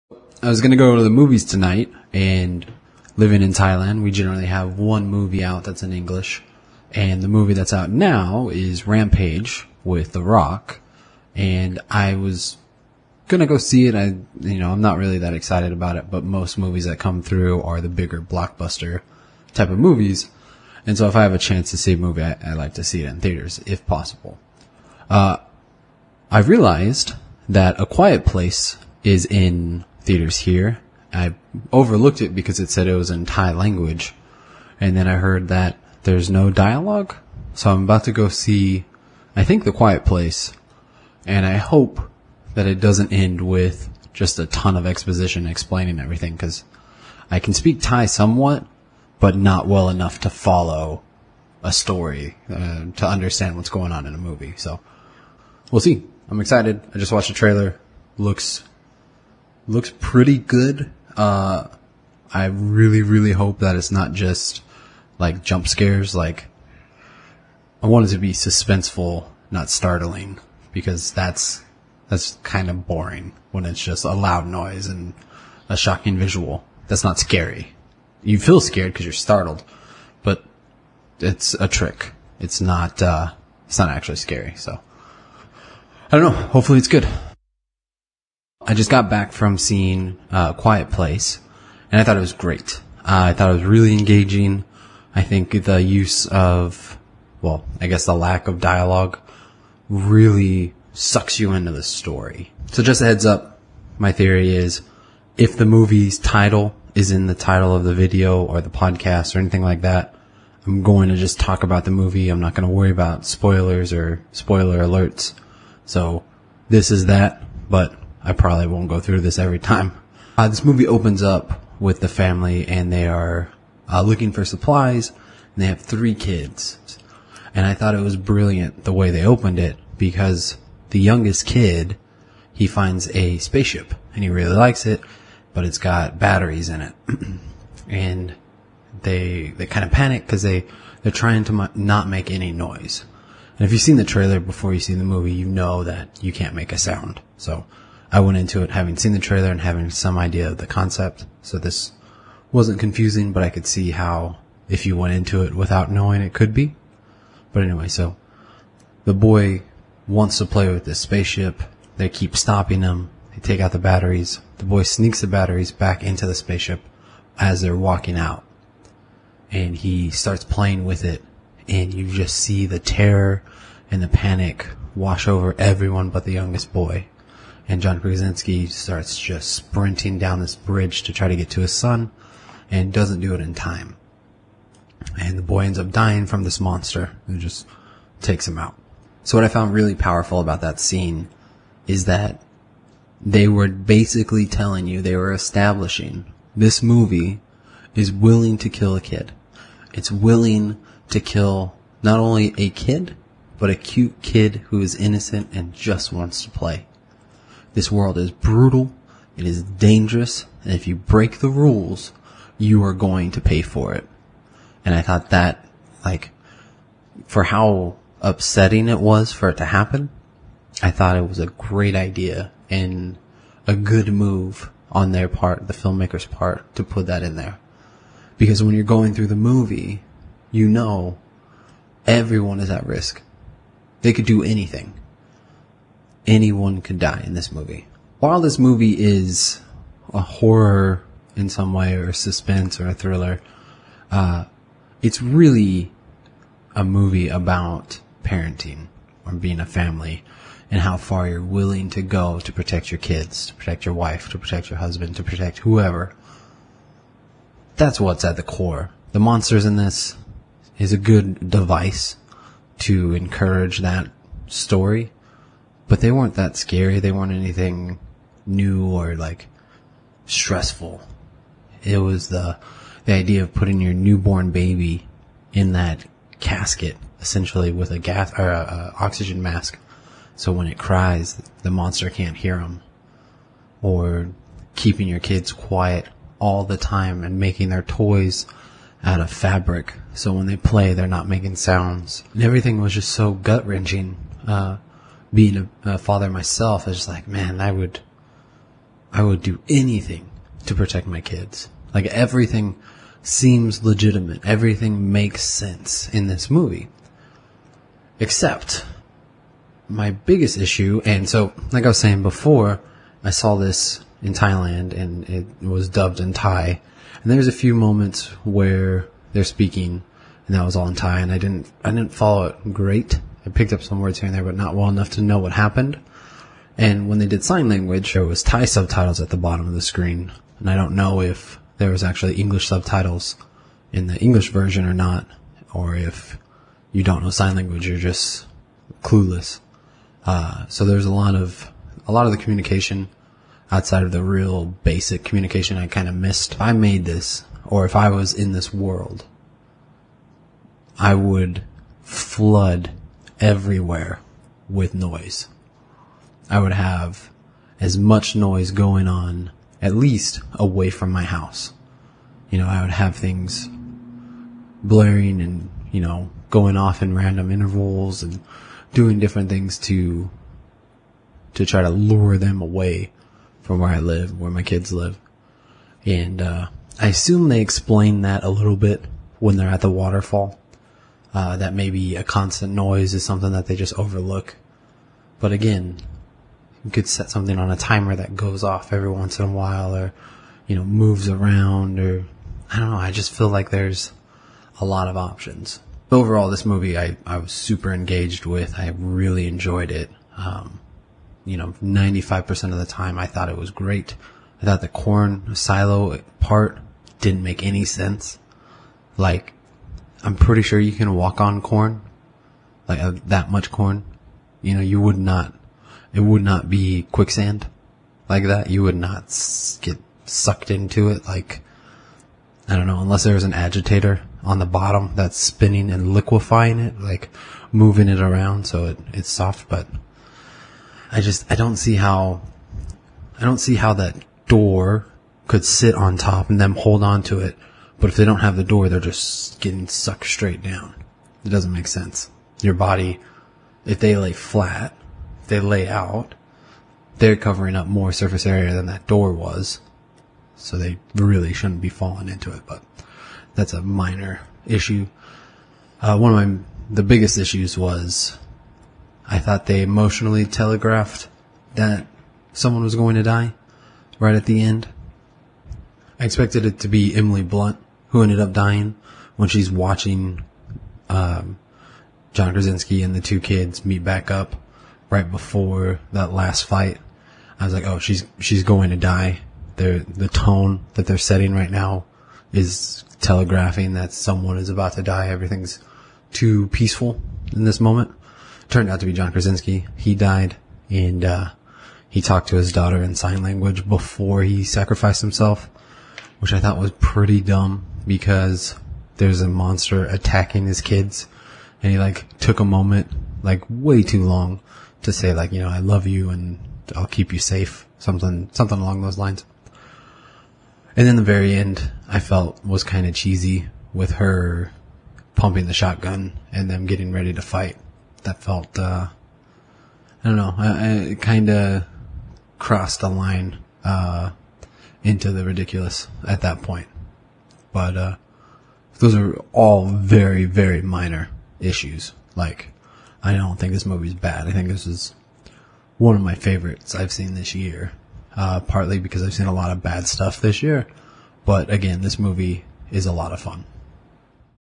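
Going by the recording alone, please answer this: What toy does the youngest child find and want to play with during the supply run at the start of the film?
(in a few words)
A spaceship.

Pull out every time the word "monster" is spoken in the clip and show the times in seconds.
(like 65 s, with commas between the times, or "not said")
186 s, 259 s, 281 s, 499 s.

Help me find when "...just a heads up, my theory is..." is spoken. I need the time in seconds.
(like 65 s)
102 s.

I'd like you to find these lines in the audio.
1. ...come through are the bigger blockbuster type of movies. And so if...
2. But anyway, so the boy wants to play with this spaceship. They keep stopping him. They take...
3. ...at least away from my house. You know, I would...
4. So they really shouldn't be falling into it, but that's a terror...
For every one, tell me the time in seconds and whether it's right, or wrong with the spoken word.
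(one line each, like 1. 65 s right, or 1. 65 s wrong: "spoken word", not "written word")
1. 16 s right
2. 157 s right
3. 359 s right
4. 450 s wrong: "minor", not "terror".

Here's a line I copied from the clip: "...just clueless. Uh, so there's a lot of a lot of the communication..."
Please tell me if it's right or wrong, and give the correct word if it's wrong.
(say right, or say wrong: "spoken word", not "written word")
right.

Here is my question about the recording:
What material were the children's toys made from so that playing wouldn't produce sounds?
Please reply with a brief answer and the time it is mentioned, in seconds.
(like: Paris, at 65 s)
Fabric, at 289 s.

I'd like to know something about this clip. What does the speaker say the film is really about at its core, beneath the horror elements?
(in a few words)
Parenting.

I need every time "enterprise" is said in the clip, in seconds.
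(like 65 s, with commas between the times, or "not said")
not said.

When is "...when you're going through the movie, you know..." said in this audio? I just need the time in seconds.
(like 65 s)
228 s.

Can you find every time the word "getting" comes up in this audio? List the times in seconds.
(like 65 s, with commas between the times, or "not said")
439 s, 516 s.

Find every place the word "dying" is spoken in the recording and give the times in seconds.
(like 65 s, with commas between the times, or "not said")
185 s, 468 s.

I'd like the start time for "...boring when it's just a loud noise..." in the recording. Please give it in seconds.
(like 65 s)
72 s.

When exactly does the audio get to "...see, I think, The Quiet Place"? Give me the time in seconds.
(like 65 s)
38 s.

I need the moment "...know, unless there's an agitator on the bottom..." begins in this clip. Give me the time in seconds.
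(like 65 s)
422 s.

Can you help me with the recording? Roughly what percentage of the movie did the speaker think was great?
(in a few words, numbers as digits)
95%.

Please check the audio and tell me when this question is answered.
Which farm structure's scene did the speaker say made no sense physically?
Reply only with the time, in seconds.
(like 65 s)
404 s.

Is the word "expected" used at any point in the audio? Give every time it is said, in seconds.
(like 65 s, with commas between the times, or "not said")
466 s.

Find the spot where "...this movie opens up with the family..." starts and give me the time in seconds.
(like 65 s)
120 s.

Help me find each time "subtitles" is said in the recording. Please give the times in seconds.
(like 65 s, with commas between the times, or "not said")
328 s, 332 s.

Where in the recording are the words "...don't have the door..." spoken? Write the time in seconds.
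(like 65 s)
438 s.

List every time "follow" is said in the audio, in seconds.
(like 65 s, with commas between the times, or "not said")
50 s, 322 s.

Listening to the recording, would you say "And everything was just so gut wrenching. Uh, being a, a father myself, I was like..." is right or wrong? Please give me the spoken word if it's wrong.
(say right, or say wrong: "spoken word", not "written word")
right.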